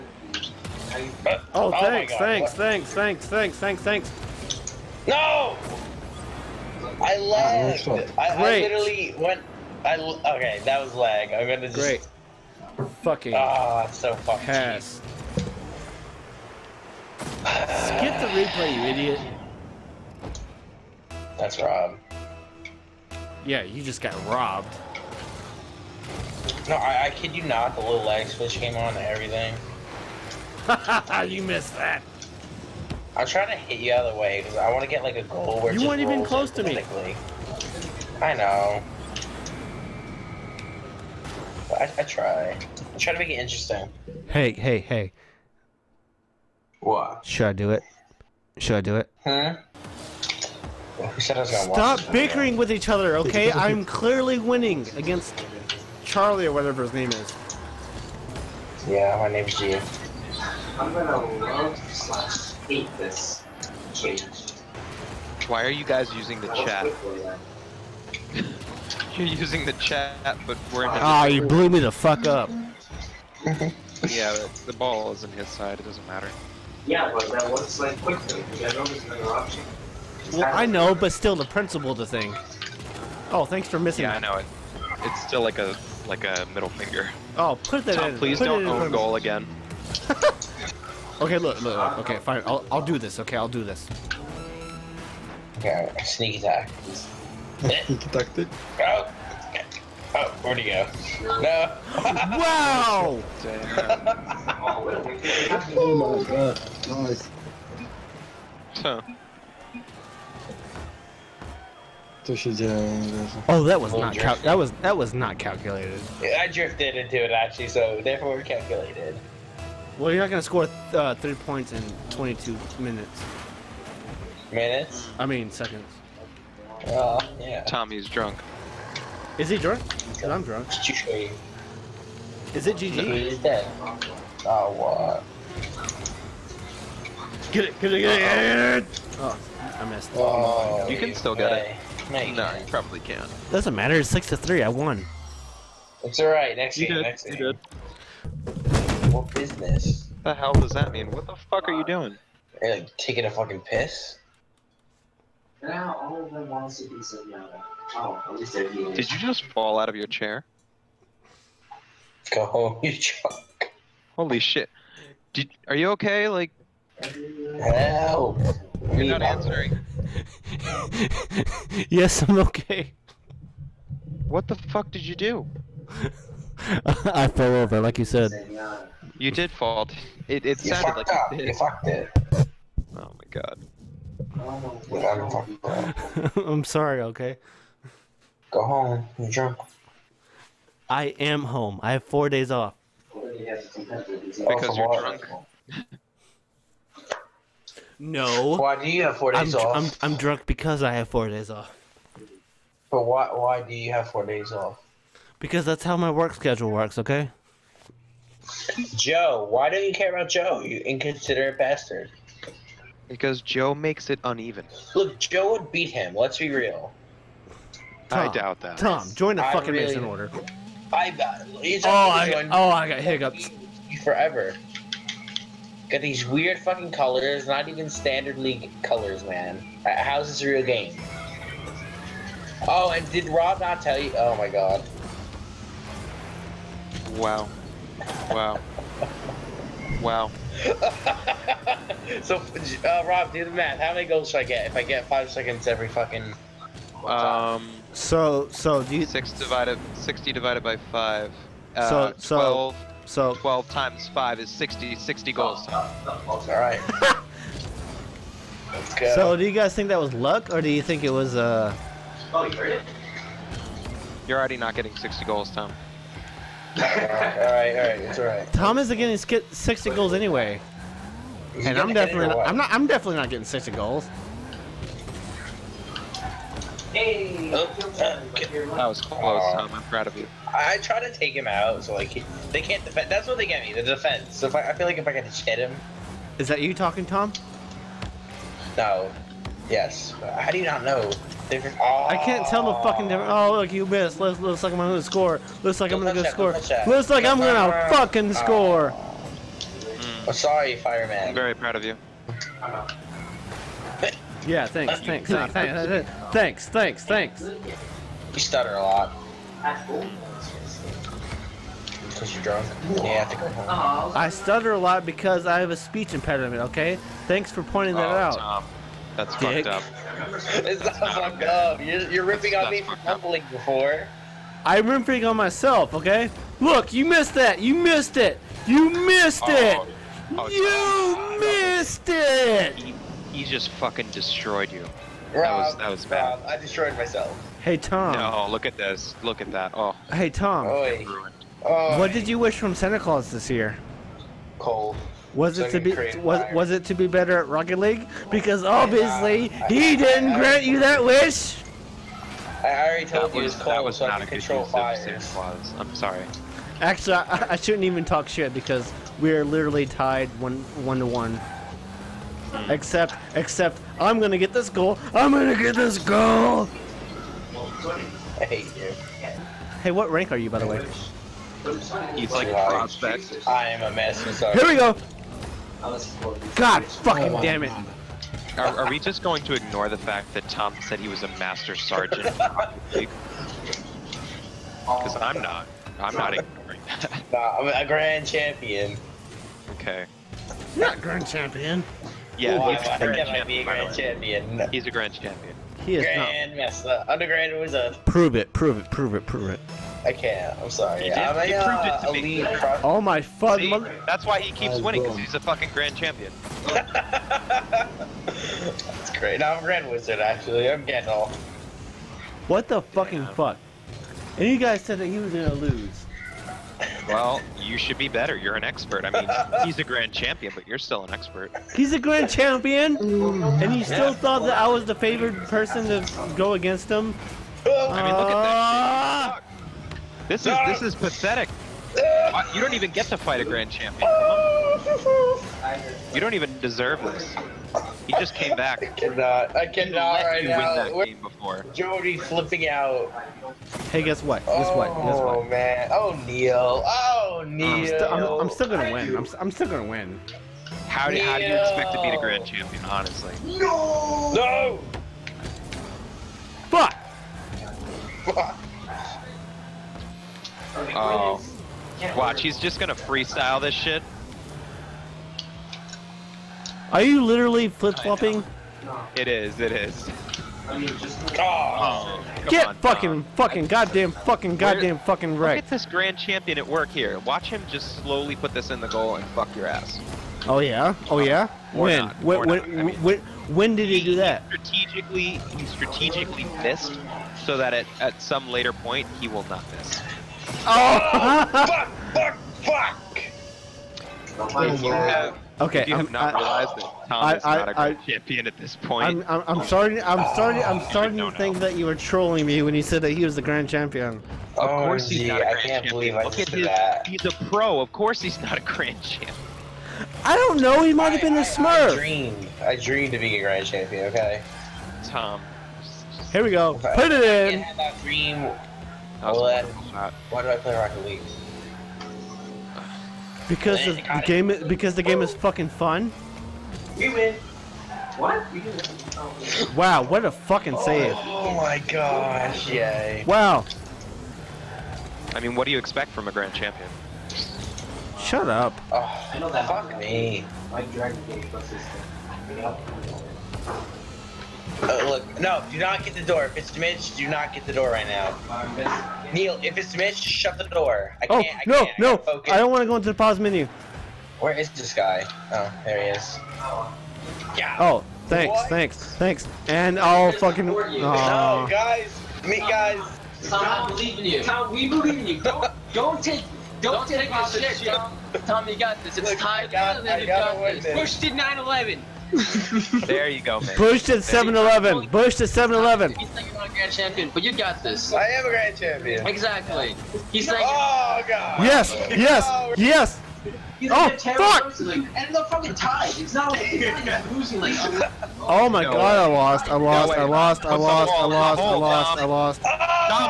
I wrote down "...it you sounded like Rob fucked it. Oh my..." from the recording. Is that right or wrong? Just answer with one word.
wrong.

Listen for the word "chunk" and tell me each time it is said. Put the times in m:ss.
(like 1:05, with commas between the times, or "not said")
2:42.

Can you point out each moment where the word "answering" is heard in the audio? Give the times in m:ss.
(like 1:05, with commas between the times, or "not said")
2:49.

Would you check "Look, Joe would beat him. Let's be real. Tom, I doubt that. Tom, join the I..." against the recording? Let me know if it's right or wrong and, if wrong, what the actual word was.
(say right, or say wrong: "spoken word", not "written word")
right.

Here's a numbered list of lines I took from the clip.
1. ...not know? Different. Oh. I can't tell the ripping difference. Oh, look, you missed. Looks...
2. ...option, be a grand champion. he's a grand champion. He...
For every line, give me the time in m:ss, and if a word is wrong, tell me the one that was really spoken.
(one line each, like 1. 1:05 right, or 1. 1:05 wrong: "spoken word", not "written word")
1. 4:50 wrong: "fucking", not "ripping"
2. 6:33 wrong: "champion", not "option".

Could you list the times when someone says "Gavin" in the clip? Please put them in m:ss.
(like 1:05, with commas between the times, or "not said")
not said.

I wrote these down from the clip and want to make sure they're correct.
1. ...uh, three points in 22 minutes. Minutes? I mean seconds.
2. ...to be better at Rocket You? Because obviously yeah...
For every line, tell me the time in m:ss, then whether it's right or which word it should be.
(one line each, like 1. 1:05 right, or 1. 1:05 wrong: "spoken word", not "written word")
1. 2:00 right
2. 5:46 wrong: "League", not "You".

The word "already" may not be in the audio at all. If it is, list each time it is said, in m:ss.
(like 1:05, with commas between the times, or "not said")
4:24, 5:52.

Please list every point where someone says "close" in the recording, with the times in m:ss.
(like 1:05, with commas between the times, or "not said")
0:36, 4:39.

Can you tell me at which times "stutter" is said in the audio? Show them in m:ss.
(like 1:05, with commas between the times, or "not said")
5:08, 5:14.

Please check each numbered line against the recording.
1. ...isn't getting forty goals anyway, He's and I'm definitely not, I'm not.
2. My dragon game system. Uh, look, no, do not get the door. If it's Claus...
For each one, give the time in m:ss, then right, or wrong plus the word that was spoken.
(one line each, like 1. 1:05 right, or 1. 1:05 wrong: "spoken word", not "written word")
1. 4:28 wrong: "sixty", not "forty"
2. 9:00 wrong: "Mitch", not "Claus".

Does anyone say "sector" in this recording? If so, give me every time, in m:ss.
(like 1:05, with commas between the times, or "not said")
not said.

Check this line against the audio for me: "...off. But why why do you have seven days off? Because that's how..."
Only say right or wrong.
wrong.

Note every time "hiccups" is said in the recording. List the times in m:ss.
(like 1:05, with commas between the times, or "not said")
3:43.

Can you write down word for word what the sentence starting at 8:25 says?
believe I Look at his, that.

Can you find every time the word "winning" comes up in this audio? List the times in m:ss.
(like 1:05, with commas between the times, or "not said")
0:54, 6:44.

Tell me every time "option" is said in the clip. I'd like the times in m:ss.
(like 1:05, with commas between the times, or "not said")
1:19.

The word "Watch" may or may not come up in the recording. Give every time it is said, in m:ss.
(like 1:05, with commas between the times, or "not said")
7:42, 7:57.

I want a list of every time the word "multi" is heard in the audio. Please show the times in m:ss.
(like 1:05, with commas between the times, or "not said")
not said.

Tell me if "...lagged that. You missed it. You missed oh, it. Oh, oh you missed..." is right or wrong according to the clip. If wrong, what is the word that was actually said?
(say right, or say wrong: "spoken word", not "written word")
wrong: "missed", not "lagged".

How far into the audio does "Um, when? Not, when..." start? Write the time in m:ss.
8:01.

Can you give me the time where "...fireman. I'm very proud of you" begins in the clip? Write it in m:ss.
5:00.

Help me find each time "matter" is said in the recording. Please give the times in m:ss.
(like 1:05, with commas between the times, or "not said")
1:16, 2:23.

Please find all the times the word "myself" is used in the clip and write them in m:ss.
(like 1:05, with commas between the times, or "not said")
5:25, 5:36.